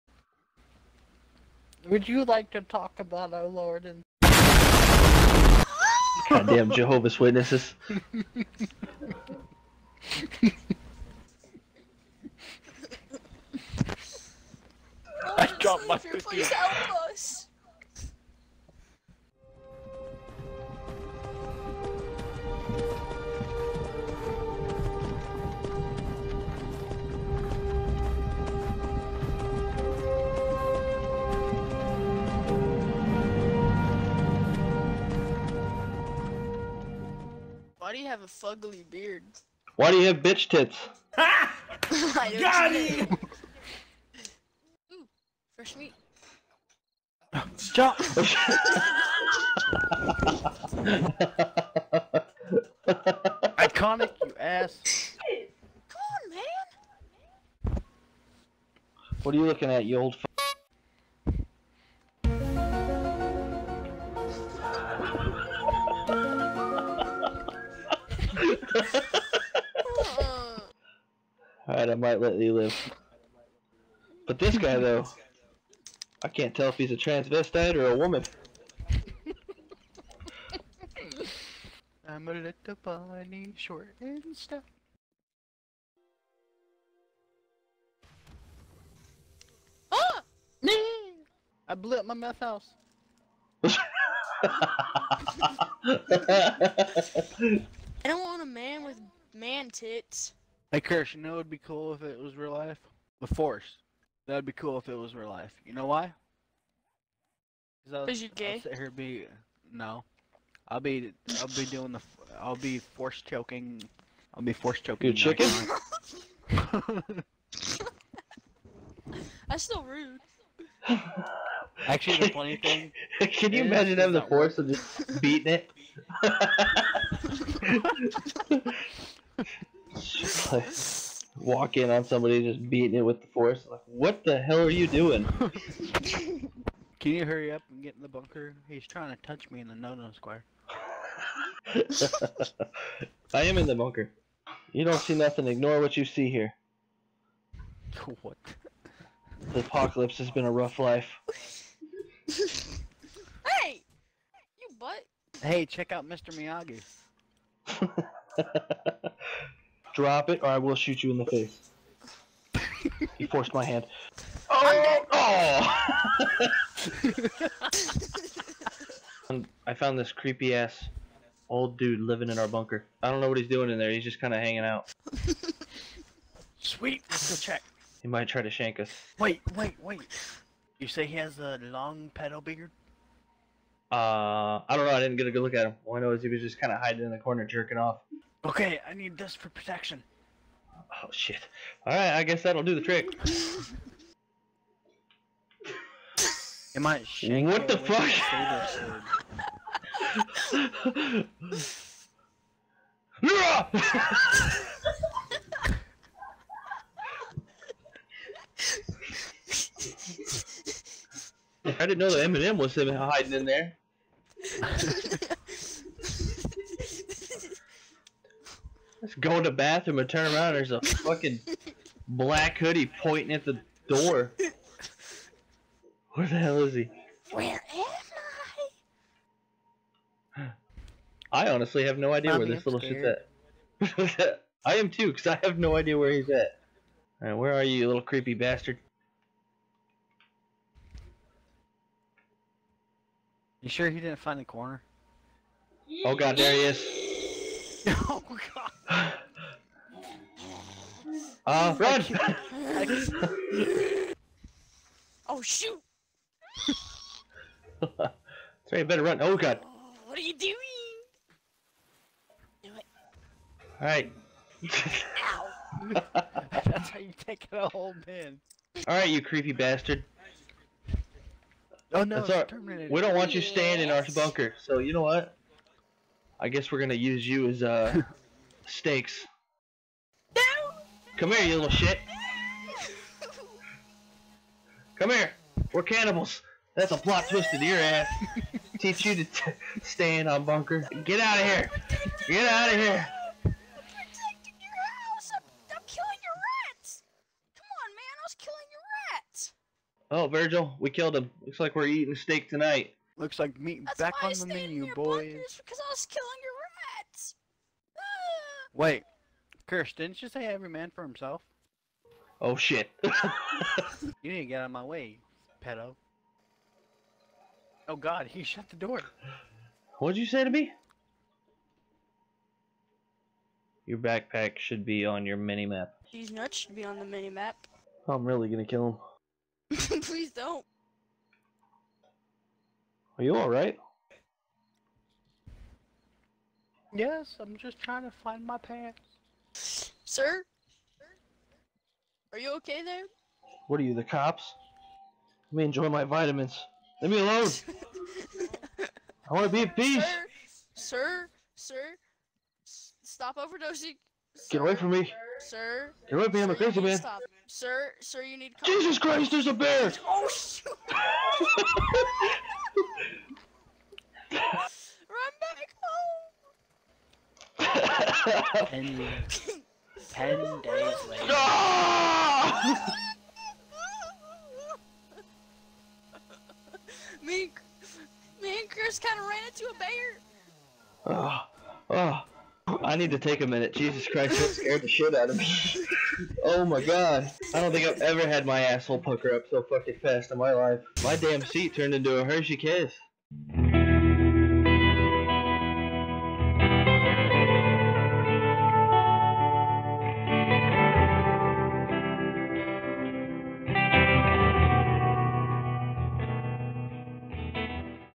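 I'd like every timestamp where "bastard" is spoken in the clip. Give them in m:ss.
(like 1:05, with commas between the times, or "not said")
3:58, 4:29.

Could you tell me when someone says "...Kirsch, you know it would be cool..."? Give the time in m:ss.
1:40.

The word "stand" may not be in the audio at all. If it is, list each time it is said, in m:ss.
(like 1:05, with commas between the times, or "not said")
4:49.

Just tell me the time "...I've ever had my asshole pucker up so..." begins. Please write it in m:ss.
6:27.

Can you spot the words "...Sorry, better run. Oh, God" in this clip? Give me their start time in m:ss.
4:18.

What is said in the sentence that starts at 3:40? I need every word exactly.
There's a fucking black hoodie pointing at the door.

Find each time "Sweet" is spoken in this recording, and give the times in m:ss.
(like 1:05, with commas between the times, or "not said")
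2:56.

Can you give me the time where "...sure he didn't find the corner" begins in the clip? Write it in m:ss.
4:03.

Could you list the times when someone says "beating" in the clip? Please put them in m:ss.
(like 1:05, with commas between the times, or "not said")
2:05, 2:12.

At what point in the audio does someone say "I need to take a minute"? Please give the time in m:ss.
6:22.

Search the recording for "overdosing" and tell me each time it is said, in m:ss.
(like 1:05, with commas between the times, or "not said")
5:53.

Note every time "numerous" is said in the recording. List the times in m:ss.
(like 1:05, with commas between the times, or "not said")
not said.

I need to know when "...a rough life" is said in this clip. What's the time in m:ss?
2:30.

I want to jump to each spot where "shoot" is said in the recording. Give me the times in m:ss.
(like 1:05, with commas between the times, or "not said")
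2:40, 4:15, 6:00.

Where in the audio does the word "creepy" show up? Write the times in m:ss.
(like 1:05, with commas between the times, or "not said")
2:50, 3:58, 4:29.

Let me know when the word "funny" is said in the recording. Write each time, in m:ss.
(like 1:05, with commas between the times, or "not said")
2:02.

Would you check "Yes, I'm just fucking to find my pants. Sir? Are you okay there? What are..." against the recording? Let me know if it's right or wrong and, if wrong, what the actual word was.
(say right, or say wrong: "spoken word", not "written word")
wrong: "trying", not "fucking".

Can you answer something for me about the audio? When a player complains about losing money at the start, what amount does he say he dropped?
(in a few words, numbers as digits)
50.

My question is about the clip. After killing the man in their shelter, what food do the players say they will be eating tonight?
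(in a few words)
Steak.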